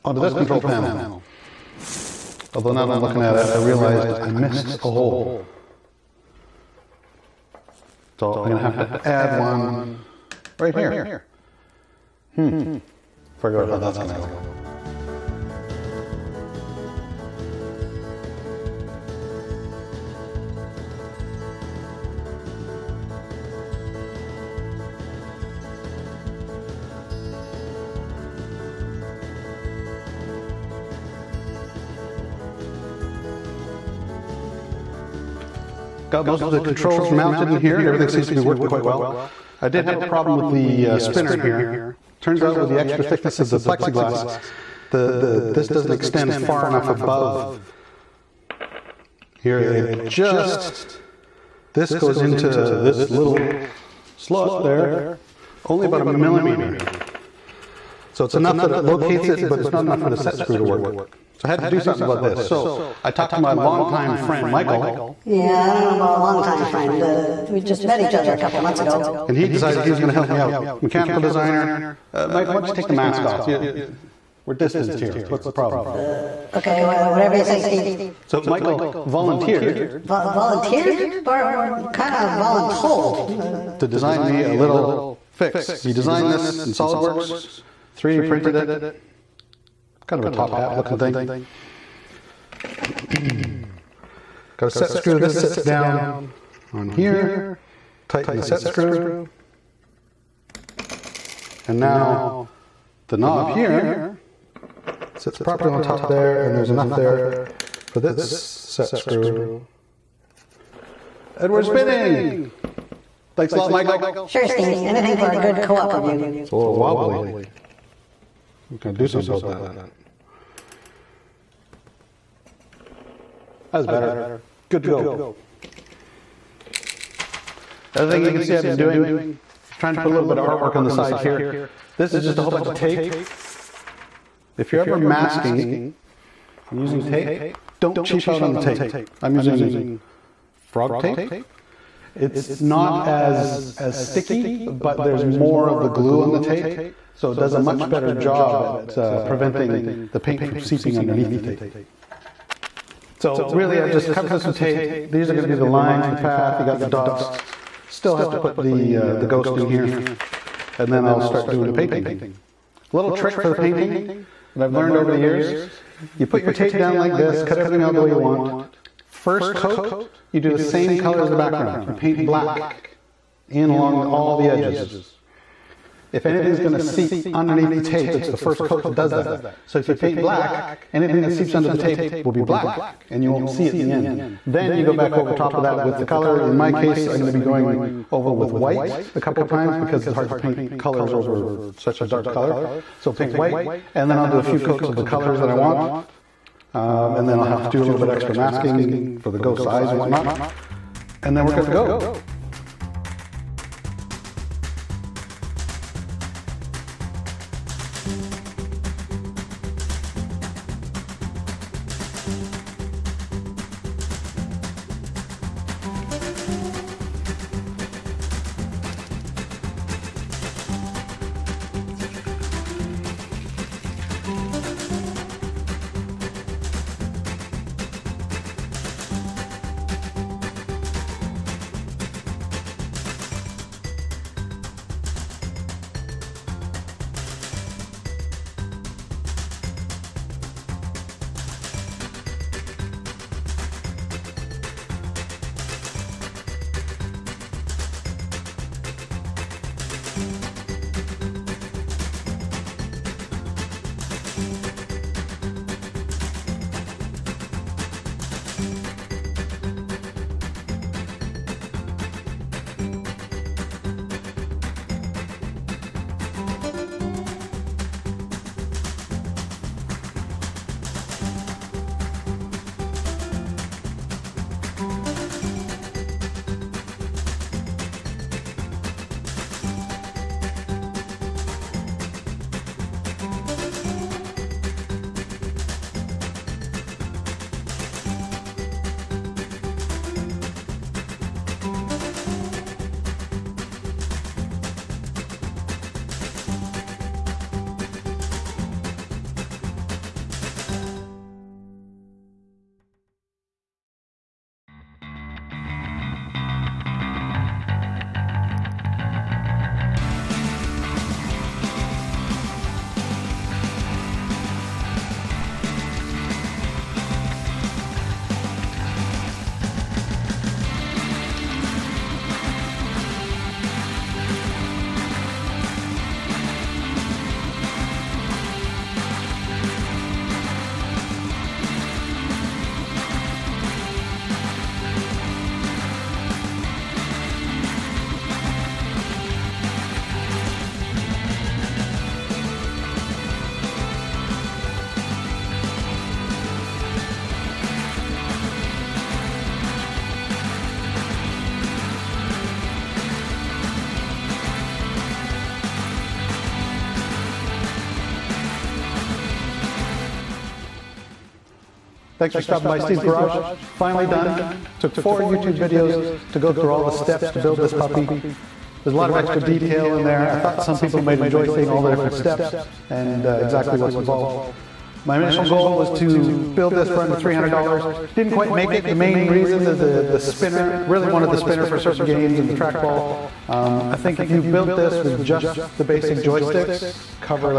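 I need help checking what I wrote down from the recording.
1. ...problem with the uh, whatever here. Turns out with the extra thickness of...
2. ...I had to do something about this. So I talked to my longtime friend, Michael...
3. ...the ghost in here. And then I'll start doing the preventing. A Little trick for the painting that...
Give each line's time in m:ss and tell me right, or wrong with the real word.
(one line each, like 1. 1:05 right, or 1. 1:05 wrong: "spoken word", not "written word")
1. 0:40 wrong: "spinner", not "whatever"
2. 1:01 right
3. 2:39 wrong: "painting", not "preventing".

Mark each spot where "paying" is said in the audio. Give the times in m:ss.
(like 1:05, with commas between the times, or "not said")
not said.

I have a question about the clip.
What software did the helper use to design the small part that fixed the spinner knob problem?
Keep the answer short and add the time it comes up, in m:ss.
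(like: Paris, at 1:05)
SolidWorks, at 1:26.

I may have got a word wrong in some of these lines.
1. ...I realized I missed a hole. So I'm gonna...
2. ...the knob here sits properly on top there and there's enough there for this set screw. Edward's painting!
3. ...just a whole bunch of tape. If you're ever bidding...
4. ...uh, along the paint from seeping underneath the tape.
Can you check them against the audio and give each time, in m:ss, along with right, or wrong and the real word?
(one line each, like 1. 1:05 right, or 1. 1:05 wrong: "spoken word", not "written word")
1. 0:03 right
2. 1:43 wrong: "bidding", not "painting"
3. 2:12 wrong: "masking", not "bidding"
4. 2:28 wrong: "preventing", not "along".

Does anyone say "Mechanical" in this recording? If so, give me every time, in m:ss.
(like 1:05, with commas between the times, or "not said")
1:10.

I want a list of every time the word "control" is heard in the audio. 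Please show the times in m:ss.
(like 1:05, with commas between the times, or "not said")
0:00, 0:36.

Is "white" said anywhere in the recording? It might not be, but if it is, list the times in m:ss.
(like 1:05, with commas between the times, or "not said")
3:08, 3:13.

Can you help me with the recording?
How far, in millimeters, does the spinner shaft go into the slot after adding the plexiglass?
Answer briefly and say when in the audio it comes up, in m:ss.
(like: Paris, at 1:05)
1 millimeter, at 0:55.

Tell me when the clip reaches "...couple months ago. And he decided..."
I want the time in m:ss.
1:08.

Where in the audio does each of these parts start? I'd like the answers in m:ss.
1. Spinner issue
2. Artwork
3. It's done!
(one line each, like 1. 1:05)
1. 0:55
2. 2:12
3. 5:06.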